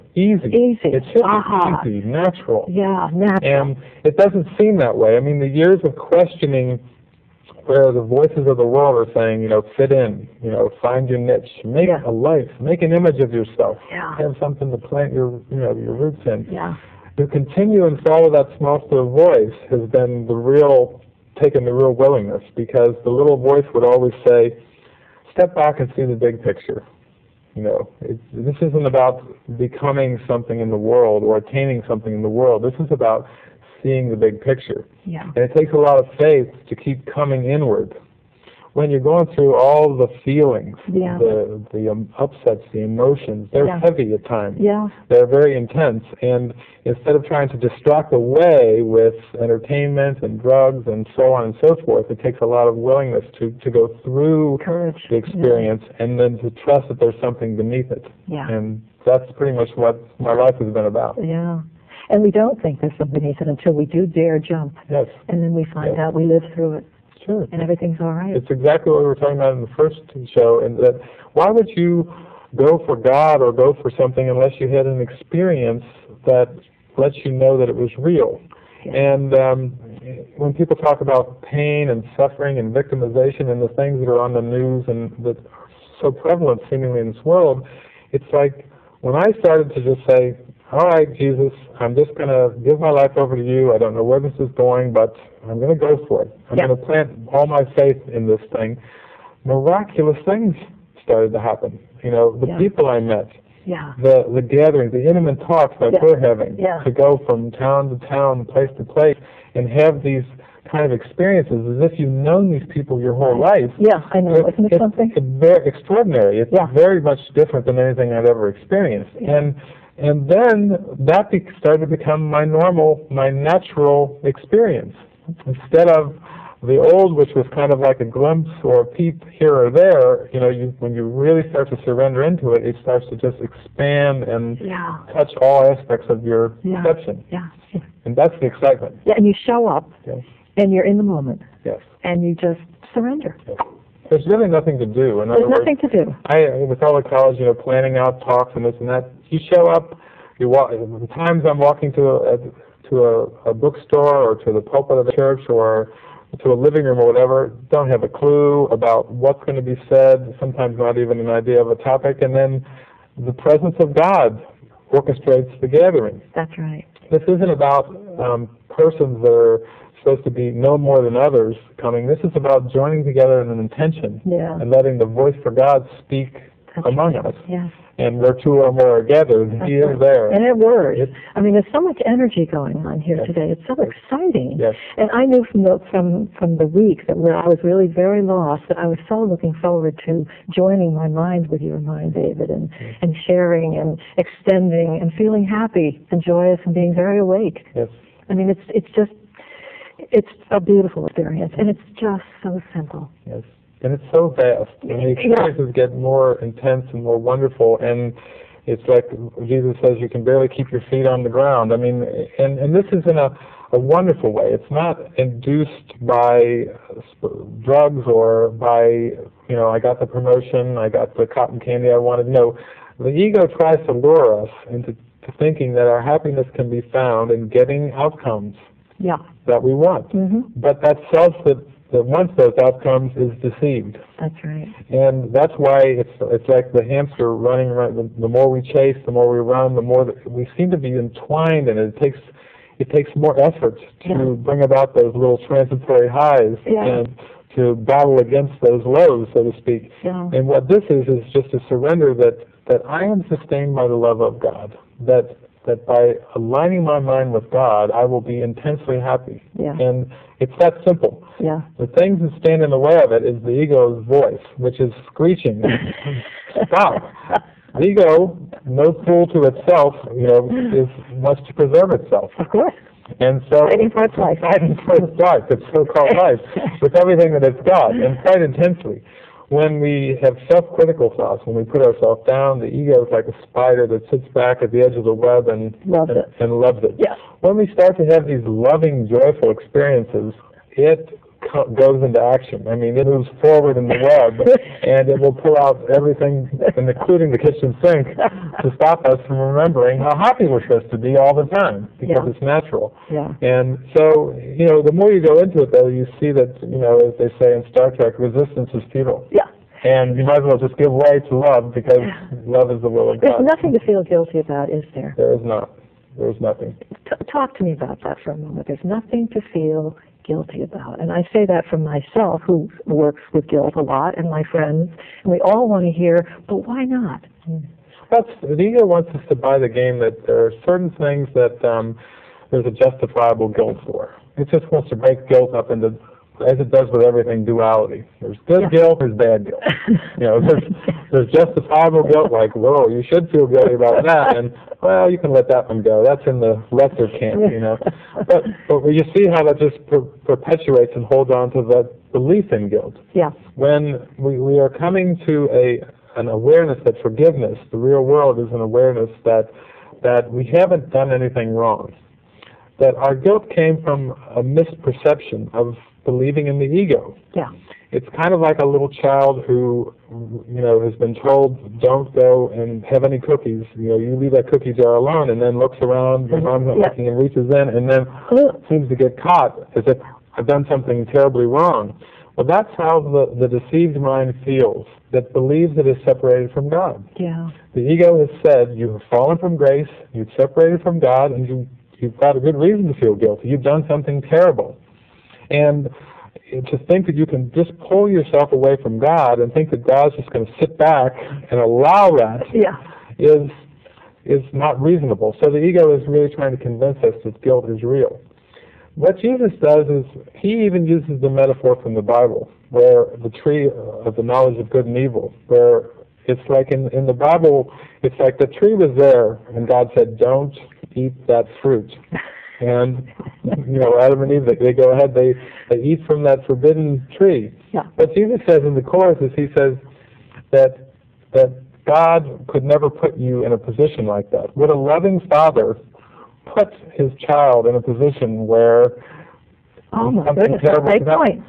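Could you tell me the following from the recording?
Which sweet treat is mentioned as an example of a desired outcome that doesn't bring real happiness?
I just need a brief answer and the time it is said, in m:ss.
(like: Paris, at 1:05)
cotton candy, at 3:41.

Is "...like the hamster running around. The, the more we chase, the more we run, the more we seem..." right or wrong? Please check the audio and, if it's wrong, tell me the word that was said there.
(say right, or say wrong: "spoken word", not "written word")
right.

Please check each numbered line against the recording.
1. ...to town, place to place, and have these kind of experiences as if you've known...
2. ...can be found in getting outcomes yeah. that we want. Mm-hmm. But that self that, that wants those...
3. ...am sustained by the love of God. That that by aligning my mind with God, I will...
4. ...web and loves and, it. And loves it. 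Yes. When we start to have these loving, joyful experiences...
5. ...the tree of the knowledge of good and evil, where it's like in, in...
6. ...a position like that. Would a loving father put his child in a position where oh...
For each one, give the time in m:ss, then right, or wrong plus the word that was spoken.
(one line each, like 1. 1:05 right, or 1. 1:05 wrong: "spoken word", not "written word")
1. 1:47 right
2. 3:46 right
3. 4:13 right
4. 4:45 right
5. 6:53 right
6. 7:13 right.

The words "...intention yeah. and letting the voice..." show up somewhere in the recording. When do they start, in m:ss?
2:53.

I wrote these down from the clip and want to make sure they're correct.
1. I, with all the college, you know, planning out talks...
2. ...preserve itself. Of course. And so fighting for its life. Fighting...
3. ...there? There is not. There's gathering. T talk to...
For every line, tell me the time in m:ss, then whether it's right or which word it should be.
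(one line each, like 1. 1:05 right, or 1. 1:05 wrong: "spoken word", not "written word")
1. 2:26 right
2. 4:31 right
3. 5:14 wrong: "nothing", not "gathering".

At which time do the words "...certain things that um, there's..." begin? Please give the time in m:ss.
5:30.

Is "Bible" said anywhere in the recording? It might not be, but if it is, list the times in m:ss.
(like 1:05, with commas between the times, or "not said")
6:51, 6:57.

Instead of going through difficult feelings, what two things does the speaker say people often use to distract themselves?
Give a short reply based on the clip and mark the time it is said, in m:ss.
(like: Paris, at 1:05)
entertainment and drugs, at 0:49.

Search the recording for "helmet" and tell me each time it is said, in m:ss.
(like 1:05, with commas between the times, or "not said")
not said.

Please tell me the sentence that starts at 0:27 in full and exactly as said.
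You know, it, this isn't about becoming something in the world or attaining something in the world.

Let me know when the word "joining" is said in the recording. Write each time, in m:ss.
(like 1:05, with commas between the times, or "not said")
2:52, 3:10.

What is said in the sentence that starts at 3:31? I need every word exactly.
I mean, and and this is in a a wonderful way.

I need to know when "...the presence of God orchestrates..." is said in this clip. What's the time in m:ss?
2:43.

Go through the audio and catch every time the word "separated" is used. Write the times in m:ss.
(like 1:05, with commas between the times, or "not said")
6:26, 6:30.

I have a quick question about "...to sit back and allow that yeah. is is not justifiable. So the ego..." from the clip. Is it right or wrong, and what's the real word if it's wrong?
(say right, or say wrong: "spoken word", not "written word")
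wrong: "reasonable", not "justifiable".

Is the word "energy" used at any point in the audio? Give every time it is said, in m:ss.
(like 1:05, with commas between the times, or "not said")
3:02.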